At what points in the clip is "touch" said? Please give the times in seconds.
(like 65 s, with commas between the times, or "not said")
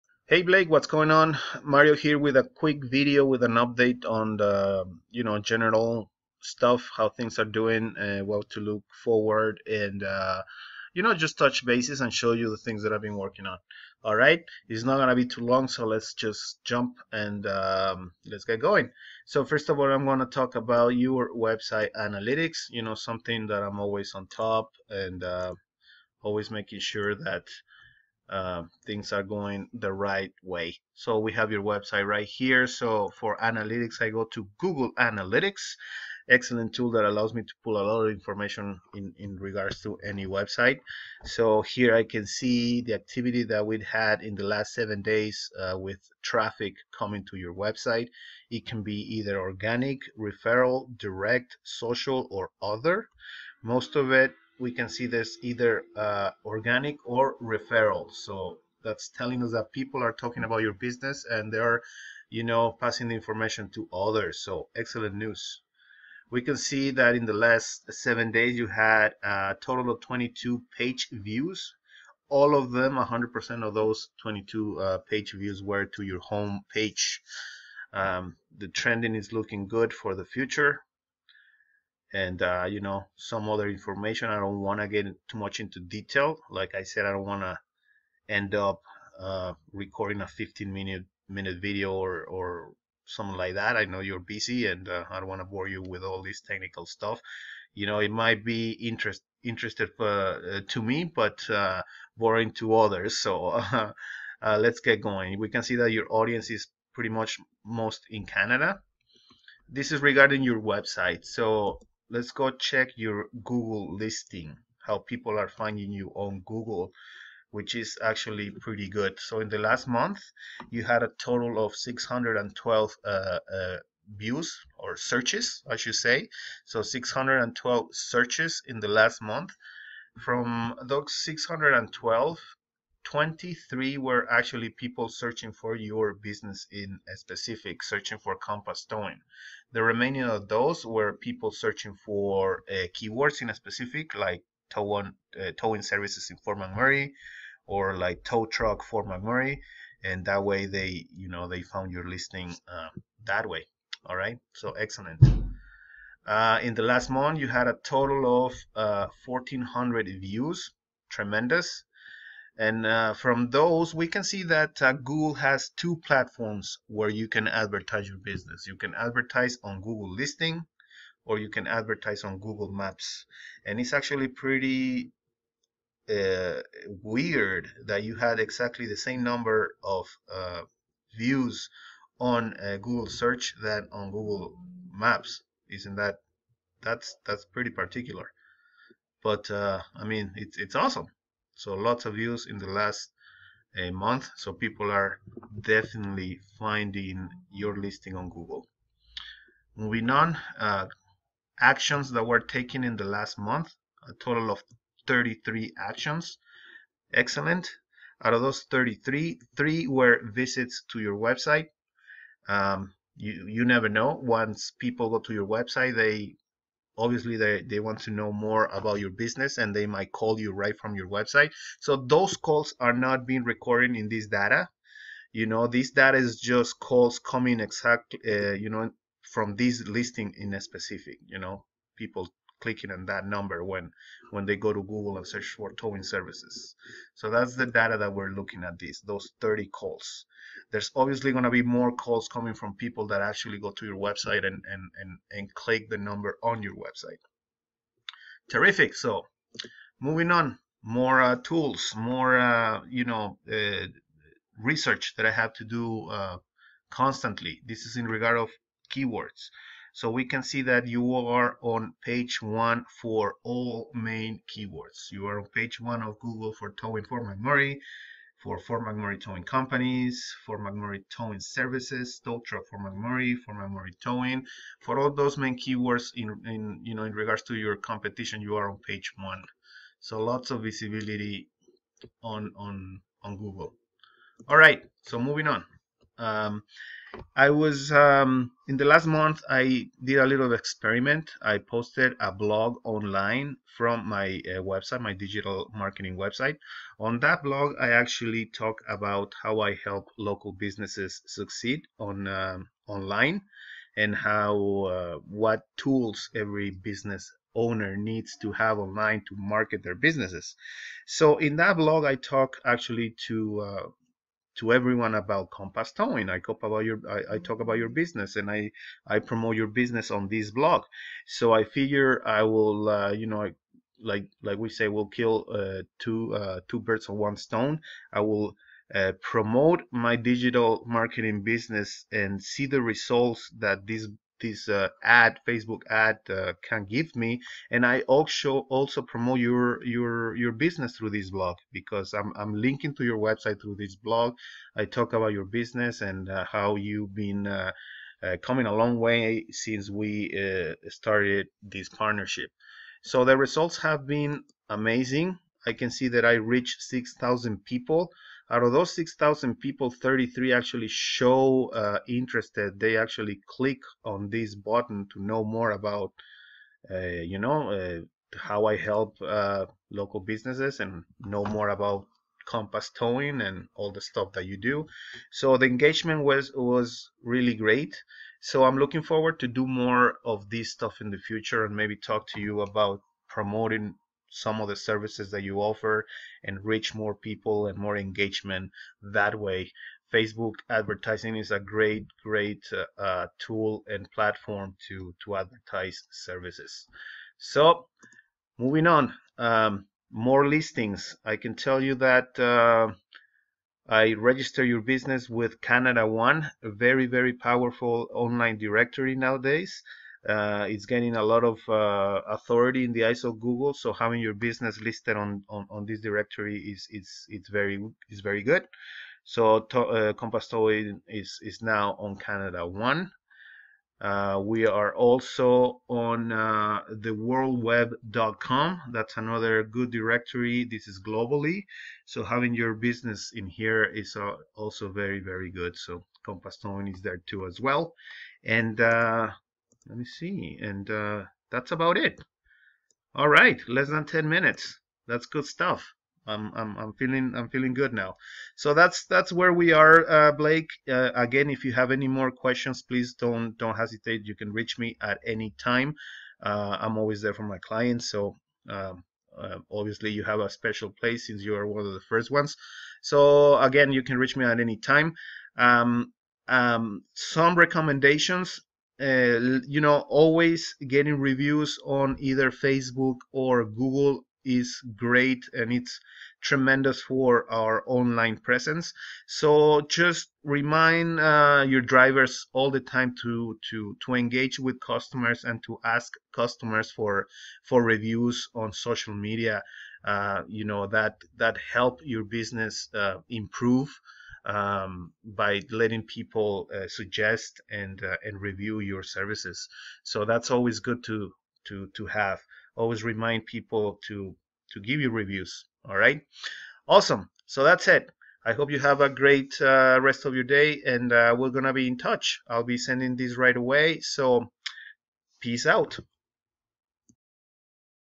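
11 s, 511 s.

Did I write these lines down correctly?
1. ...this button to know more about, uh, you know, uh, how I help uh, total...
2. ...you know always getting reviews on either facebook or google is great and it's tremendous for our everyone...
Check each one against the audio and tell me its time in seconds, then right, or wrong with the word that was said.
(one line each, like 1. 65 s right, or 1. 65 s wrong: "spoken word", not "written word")
1. 364 s wrong: "local", not "total"
2. 469 s wrong: "online", not "everyone".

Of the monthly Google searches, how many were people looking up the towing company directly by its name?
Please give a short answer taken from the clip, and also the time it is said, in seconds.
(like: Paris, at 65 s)
23, at 133 s.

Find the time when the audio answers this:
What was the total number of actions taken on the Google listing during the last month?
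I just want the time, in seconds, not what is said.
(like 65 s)
204 s.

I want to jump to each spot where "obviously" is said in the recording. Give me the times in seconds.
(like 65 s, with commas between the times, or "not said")
217 s, 240 s, 459 s.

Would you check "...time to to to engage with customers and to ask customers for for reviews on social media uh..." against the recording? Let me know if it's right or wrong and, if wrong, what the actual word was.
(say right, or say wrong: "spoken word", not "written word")
right.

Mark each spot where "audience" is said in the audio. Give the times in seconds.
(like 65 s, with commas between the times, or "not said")
106 s.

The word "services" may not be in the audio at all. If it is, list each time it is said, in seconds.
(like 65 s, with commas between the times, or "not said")
145 s, 236 s, 271 s, 384 s, 396 s, 499 s.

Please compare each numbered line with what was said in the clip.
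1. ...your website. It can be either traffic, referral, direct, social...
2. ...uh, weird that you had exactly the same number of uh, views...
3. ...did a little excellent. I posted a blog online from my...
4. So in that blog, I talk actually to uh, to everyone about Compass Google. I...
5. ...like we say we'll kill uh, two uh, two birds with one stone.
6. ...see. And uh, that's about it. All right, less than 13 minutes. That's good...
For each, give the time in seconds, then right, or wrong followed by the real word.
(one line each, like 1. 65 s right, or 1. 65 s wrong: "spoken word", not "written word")
1. 47 s wrong: "organic", not "traffic"
2. 176 s right
3. 290 s wrong: "experiment", not "excellent"
4. 311 s wrong: "Towing", not "Google"
5. 324 s right
6. 440 s wrong: "10", not "13".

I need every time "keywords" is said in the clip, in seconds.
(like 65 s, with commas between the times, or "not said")
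142 s, 258 s, 264 s, 275 s.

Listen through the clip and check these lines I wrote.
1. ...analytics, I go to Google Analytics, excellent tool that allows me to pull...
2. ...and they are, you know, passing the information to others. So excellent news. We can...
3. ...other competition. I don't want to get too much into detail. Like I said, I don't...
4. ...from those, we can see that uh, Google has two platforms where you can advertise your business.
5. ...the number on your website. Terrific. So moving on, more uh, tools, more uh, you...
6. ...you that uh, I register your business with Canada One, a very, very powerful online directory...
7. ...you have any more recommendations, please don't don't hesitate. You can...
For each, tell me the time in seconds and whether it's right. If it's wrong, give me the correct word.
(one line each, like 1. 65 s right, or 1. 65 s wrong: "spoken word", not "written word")
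1. 33 s right
2. 61 s right
3. 83 s wrong: "information", not "competition"
4. 163 s right
5. 245 s right
6. 401 s right
7. 451 s wrong: "questions", not "recommendations".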